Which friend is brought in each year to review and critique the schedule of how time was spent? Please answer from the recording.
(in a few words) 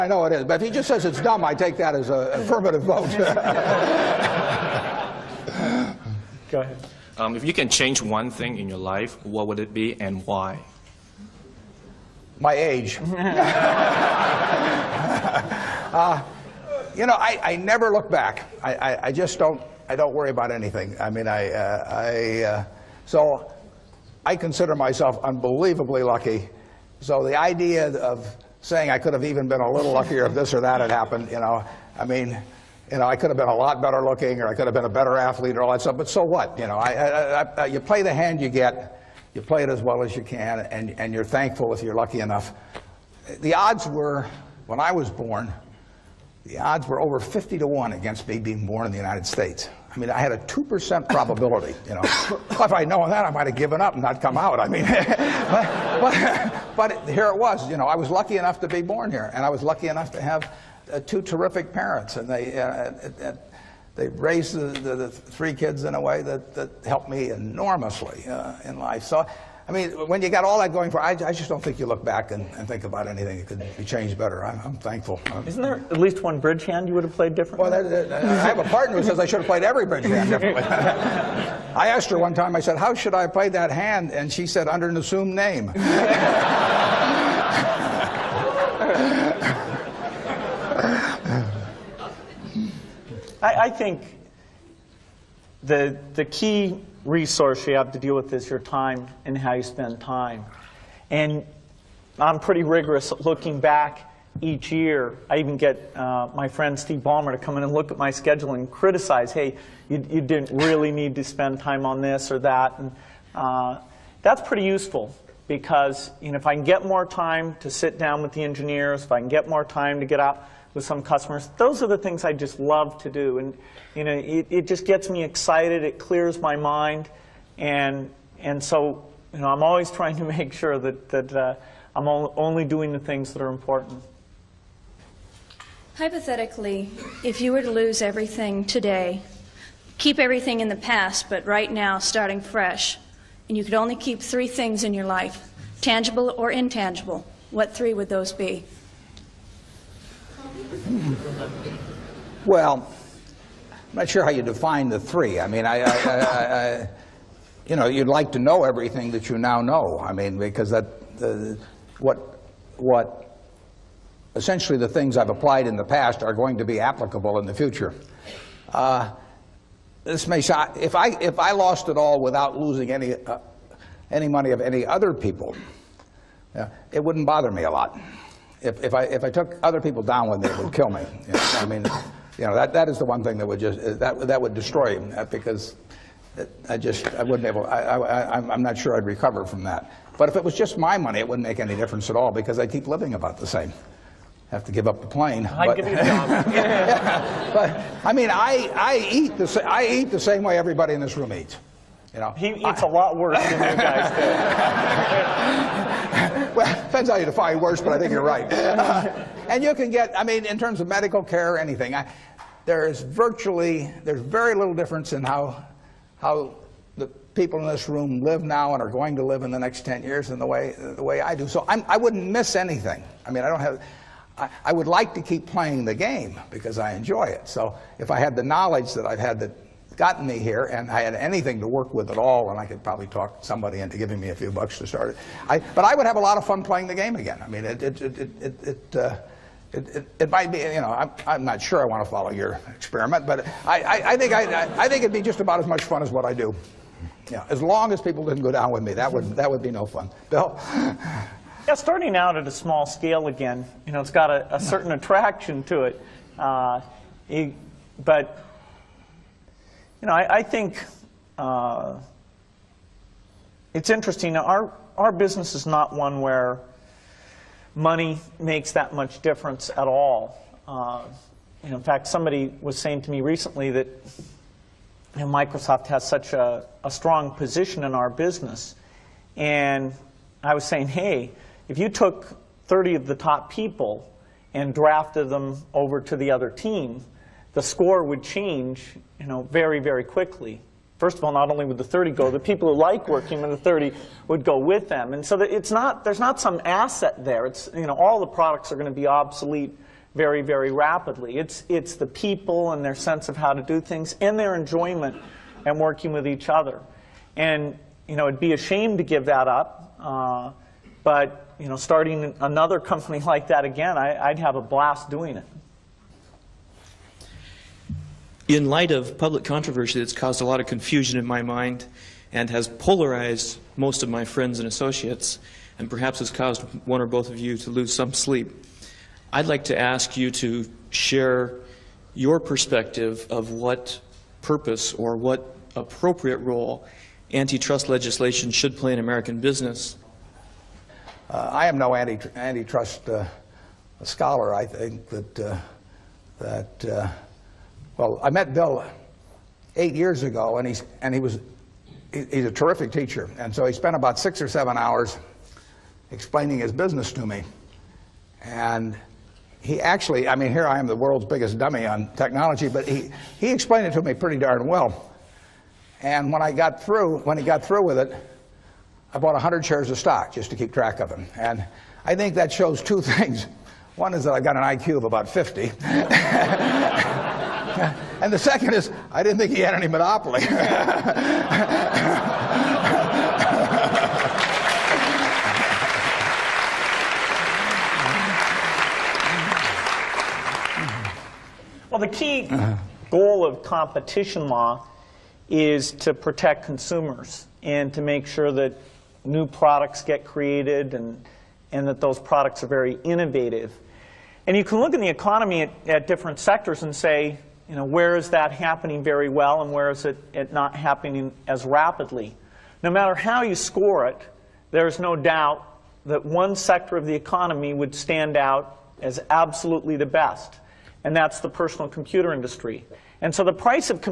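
Steve Ballmer.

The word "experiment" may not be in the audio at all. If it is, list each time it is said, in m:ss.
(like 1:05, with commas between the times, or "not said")
4:02.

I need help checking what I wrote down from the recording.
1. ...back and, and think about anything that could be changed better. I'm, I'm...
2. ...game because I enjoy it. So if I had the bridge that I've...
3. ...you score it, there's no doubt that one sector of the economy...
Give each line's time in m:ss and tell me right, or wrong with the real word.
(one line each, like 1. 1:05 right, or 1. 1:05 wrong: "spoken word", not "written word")
1. 1:12 right
2. 3:45 wrong: "knowledge", not "bridge"
3. 6:53 right.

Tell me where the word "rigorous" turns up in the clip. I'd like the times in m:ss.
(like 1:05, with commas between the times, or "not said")
1:42.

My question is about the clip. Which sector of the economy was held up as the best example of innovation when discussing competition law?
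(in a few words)
personal computer industry.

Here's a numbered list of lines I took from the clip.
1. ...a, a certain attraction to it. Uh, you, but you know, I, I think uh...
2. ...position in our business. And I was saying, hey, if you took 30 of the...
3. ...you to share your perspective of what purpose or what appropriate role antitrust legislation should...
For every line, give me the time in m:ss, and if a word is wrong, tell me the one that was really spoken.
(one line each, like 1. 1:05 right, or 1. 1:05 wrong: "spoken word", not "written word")
1. 4:14 right
2. 4:37 right
3. 5:30 right.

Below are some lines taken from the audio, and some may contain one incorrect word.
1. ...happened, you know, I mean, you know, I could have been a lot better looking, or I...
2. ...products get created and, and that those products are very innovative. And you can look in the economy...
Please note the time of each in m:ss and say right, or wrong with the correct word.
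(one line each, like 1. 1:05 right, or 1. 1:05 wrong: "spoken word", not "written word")
1. 0:30 right
2. 6:39 right.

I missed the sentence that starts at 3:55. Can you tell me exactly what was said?
I, but I would have a lot of fun playing the game again.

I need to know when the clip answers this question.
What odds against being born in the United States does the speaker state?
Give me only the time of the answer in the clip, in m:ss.
0:47.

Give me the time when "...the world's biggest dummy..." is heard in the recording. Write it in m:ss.
6:00.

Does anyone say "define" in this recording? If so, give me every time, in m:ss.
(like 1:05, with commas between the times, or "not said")
2:34, 3:27.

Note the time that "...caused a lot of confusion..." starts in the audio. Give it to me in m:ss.
5:20.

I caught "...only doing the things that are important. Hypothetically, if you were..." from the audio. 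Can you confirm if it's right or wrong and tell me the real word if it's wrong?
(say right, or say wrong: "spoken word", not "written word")
right.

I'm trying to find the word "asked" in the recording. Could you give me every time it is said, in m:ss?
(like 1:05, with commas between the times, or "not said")
1:21.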